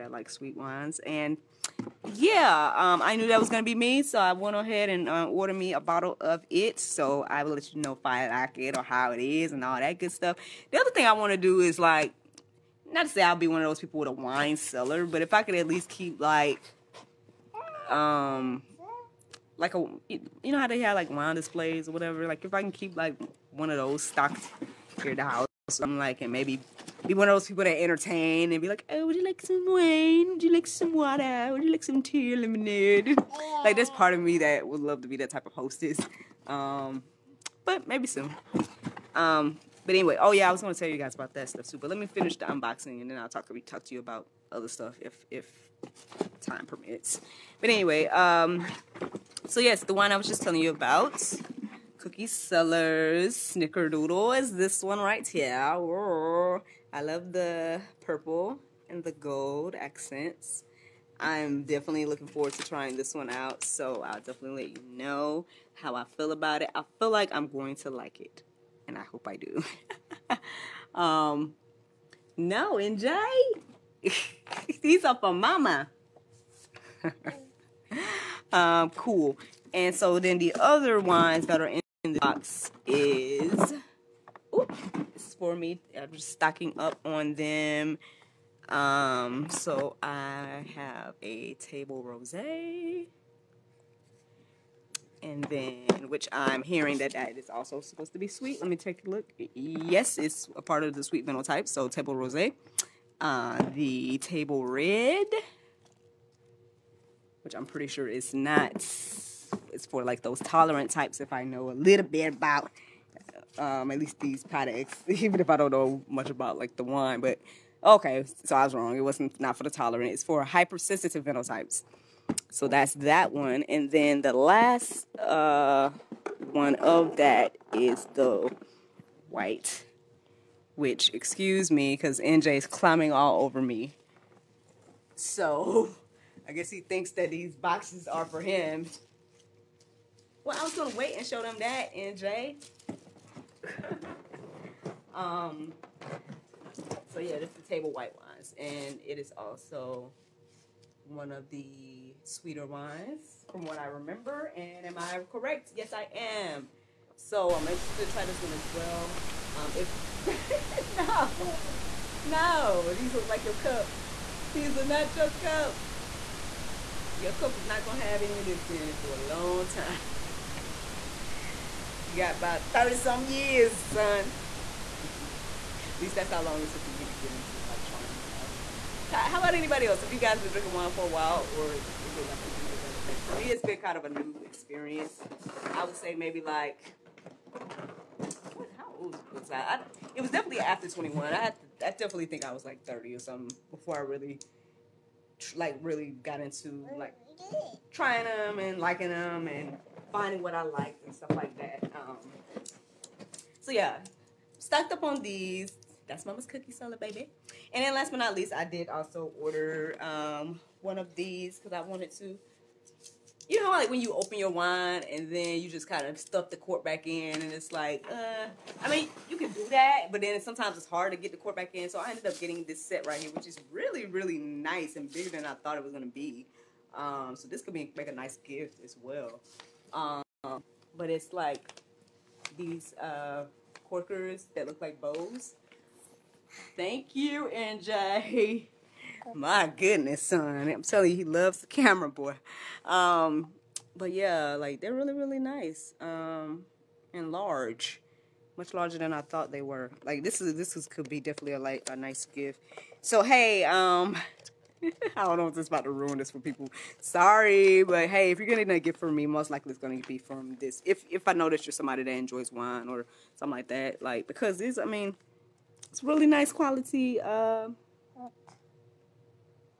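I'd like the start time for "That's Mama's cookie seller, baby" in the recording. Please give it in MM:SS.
03:26.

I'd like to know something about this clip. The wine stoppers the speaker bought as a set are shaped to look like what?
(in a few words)
bows.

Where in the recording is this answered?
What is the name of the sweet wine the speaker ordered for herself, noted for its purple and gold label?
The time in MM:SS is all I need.
00:51.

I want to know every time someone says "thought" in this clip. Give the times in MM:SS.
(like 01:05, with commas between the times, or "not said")
03:45, 04:09.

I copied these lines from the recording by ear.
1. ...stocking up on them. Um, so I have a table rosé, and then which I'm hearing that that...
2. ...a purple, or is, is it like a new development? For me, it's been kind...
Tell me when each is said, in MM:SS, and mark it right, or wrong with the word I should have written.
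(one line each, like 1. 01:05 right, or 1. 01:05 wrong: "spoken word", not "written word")
1. 01:26 right
2. 03:01 wrong: "while", not "purple".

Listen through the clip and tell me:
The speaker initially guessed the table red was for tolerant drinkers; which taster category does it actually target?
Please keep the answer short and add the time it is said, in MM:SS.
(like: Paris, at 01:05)
hypersensitive, at 02:00.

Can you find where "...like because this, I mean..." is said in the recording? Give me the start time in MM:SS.
04:24.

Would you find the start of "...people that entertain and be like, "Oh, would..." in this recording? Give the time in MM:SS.
00:27.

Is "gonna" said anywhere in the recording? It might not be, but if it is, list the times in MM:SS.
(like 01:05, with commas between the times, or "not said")
00:40, 02:47, 03:45, 04:19.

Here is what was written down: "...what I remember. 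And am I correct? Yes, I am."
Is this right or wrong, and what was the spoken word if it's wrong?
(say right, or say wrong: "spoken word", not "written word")
right.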